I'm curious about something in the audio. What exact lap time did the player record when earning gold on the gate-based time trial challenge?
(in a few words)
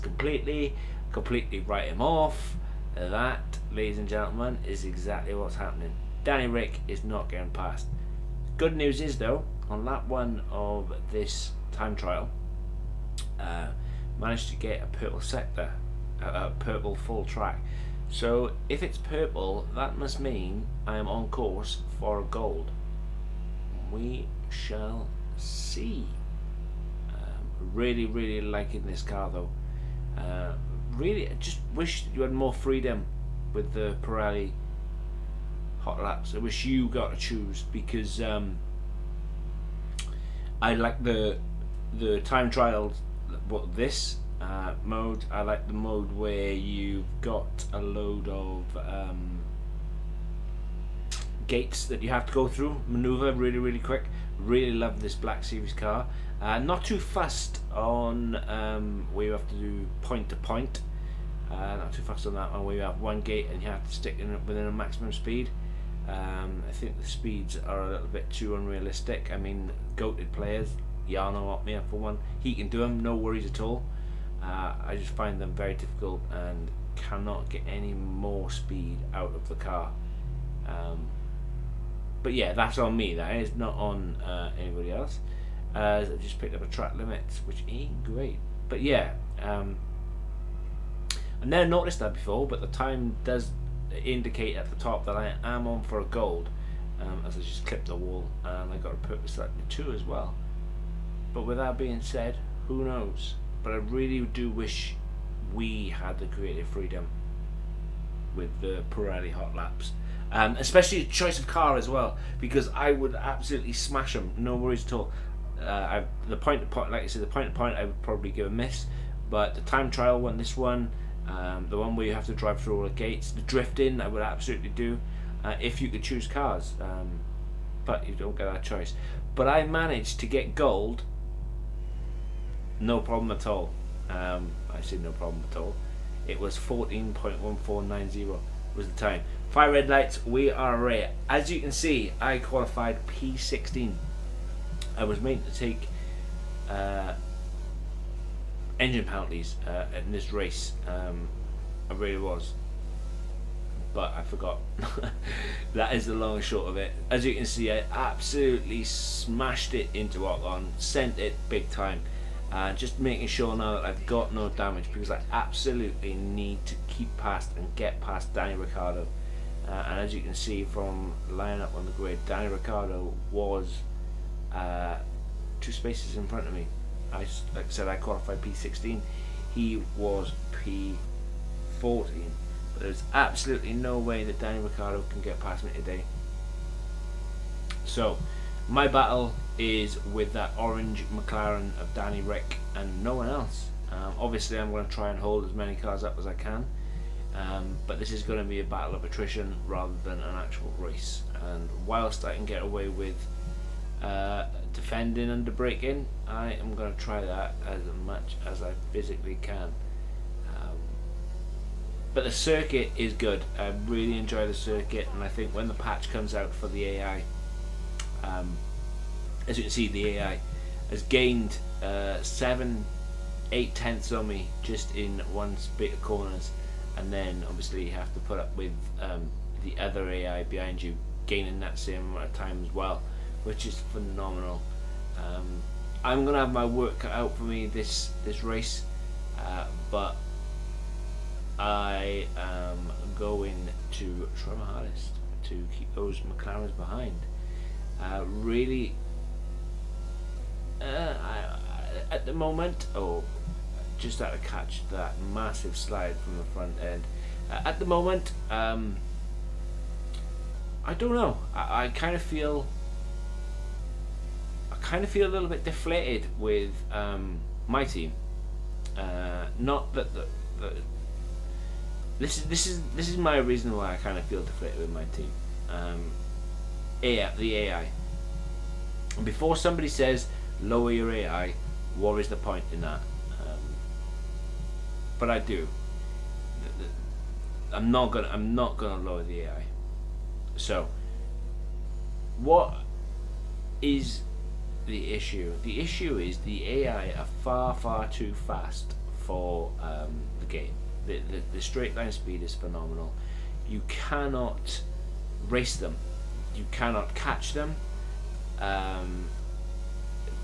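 14.1490.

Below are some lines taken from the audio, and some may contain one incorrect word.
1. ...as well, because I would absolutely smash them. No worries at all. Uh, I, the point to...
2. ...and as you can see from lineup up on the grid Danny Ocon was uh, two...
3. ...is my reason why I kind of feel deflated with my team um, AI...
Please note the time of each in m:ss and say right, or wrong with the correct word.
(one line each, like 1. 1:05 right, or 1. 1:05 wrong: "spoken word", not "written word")
1. 1:51 right
2. 2:49 wrong: "Ricciardo", not "Ocon"
3. 4:33 right.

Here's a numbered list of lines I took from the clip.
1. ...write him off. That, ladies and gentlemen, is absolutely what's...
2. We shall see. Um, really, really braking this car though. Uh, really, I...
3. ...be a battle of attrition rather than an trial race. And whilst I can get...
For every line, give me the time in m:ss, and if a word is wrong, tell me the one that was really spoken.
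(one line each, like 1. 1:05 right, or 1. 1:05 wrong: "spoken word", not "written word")
1. 0:01 wrong: "exactly", not "absolutely"
2. 0:23 wrong: "liking", not "braking"
3. 3:18 wrong: "actual", not "trial".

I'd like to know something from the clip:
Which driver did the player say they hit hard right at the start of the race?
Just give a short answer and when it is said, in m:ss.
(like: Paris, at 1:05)
Ocon, at 2:40.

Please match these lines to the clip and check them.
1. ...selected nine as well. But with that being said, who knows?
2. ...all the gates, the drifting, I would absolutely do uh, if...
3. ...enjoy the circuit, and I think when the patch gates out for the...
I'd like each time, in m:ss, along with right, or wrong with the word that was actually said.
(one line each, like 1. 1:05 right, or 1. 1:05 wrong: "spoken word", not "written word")
1. 1:39 wrong: "two", not "nine"
2. 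2:02 right
3. 3:34 wrong: "comes", not "gates".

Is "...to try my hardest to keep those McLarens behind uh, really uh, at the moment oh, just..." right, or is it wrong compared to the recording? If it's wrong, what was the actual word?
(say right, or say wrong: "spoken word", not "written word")
right.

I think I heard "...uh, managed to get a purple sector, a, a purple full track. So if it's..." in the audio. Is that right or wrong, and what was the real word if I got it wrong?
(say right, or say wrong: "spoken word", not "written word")
right.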